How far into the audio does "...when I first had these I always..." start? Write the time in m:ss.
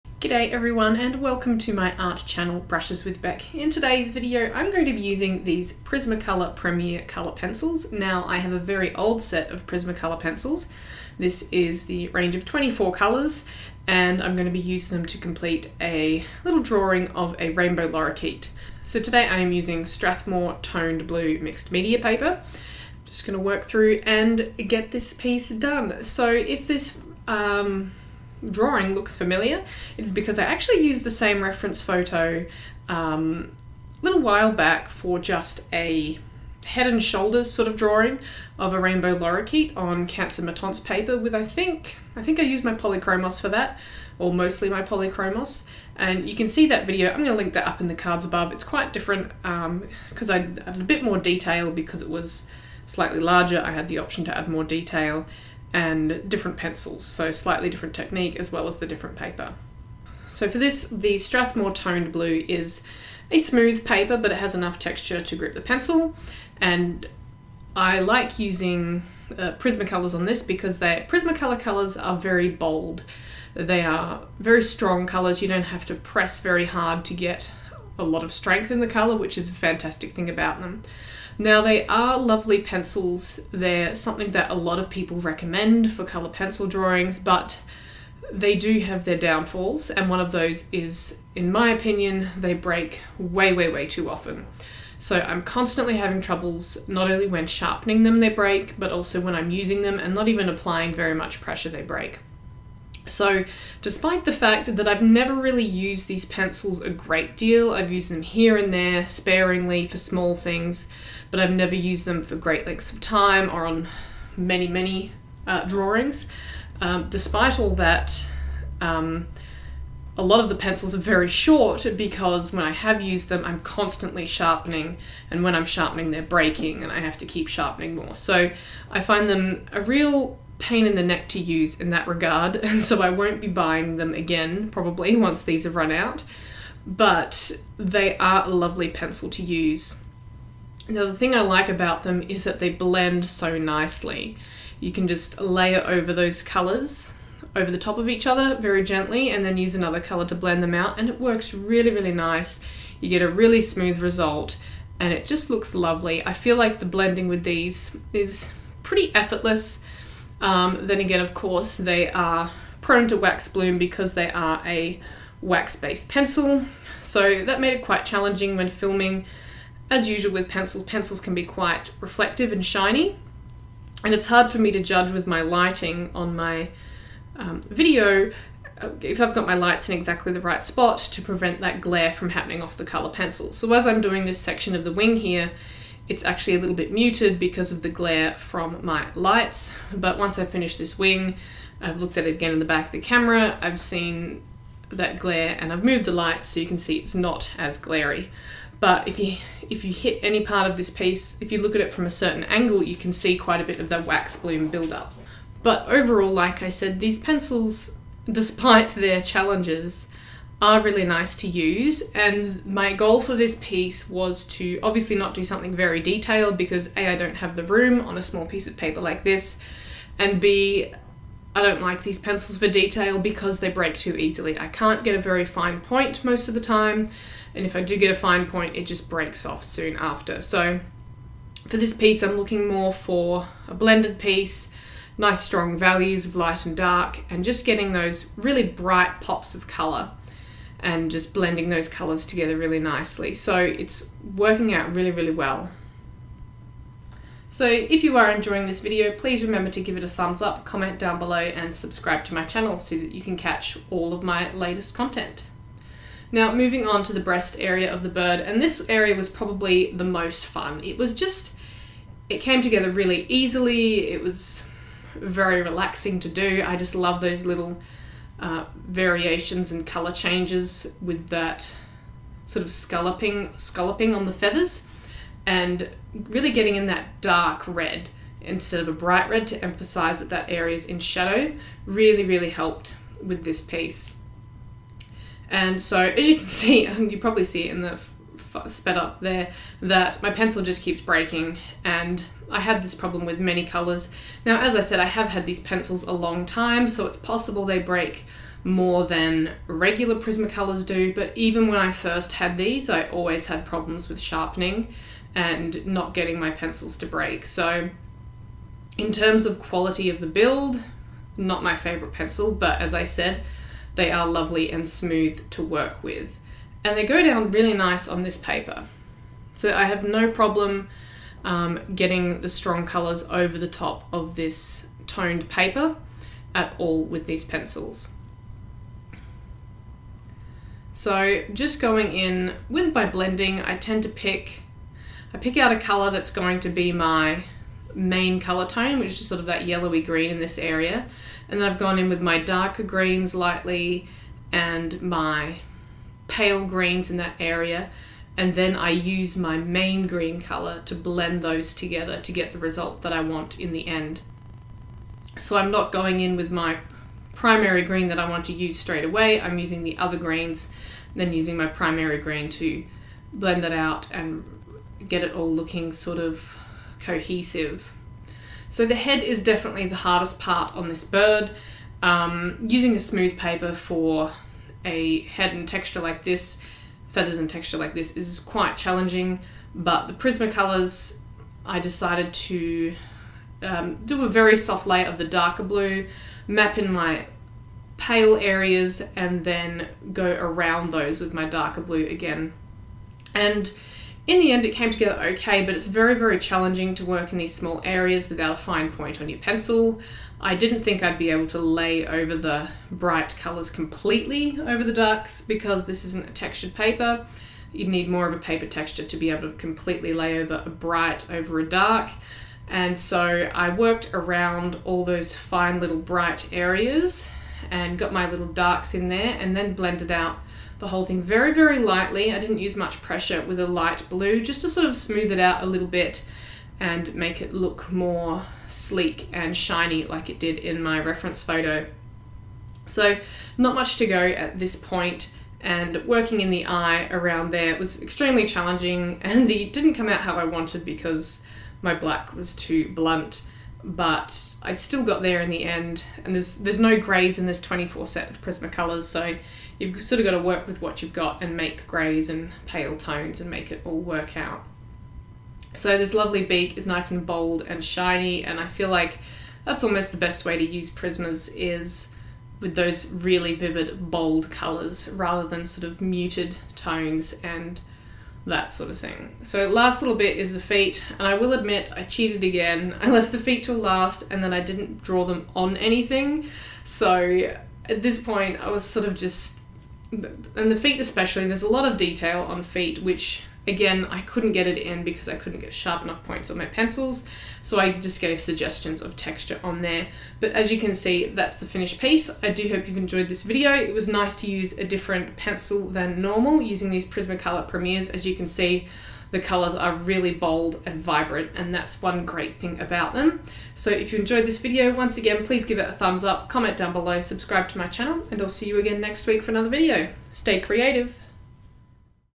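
5:01.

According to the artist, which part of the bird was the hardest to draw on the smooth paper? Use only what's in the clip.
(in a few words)
The head.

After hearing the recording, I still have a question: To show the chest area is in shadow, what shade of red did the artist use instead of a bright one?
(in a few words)
Dark red.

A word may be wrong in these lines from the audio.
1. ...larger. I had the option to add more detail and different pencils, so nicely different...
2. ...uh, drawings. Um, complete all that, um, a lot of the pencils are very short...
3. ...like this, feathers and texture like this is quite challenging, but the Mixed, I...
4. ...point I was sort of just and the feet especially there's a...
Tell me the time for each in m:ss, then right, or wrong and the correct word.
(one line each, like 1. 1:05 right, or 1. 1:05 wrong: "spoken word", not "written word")
1. 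0:53 wrong: "slightly", not "nicely"
2. 1:55 wrong: "despite", not "complete"
3. 6:16 wrong: "Prismacolors", not "Mixed"
4. 7:58 right.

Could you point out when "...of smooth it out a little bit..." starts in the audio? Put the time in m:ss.
7:04.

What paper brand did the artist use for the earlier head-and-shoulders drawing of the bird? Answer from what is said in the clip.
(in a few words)
Canson Mi-Teintes.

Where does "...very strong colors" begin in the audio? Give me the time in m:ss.
1:14.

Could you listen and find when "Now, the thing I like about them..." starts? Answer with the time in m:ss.
2:20.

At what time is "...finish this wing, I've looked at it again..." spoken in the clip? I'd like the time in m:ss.
3:10.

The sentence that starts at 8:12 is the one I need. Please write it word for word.
I do hope you've enjoyed this video.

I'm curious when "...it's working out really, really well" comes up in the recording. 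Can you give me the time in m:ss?
4:03.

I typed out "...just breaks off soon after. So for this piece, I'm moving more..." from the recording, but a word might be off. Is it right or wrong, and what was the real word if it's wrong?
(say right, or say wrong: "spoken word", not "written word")
wrong: "looking", not "moving".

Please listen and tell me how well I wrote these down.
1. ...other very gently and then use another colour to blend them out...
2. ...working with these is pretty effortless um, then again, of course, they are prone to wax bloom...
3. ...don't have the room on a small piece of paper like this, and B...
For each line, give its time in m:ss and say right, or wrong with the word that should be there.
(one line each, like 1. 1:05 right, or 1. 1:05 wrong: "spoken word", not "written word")
1. 2:28 right
2. 2:36 wrong: "blending", not "working"
3. 3:37 right.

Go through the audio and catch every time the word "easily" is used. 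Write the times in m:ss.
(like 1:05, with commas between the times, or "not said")
3:44, 4:23.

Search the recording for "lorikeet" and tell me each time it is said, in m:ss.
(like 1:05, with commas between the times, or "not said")
0:17, 0:39.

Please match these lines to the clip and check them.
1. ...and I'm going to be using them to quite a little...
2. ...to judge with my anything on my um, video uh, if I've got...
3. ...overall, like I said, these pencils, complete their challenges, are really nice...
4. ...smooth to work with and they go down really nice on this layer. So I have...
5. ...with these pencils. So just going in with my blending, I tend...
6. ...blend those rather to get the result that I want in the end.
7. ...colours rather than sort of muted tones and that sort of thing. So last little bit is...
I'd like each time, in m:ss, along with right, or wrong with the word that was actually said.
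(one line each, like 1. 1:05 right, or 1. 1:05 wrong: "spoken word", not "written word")
1. 0:13 wrong: "complete", not "quite"
2. 2:54 wrong: "lighting", not "anything"
3. 3:25 wrong: "despite", not "complete"
4. 5:14 wrong: "paper", not "layer"
5. 5:27 right
6. 5:50 wrong: "together", not "rather"
7. 7:44 right.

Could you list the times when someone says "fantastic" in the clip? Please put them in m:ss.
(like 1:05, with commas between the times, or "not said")
1:19.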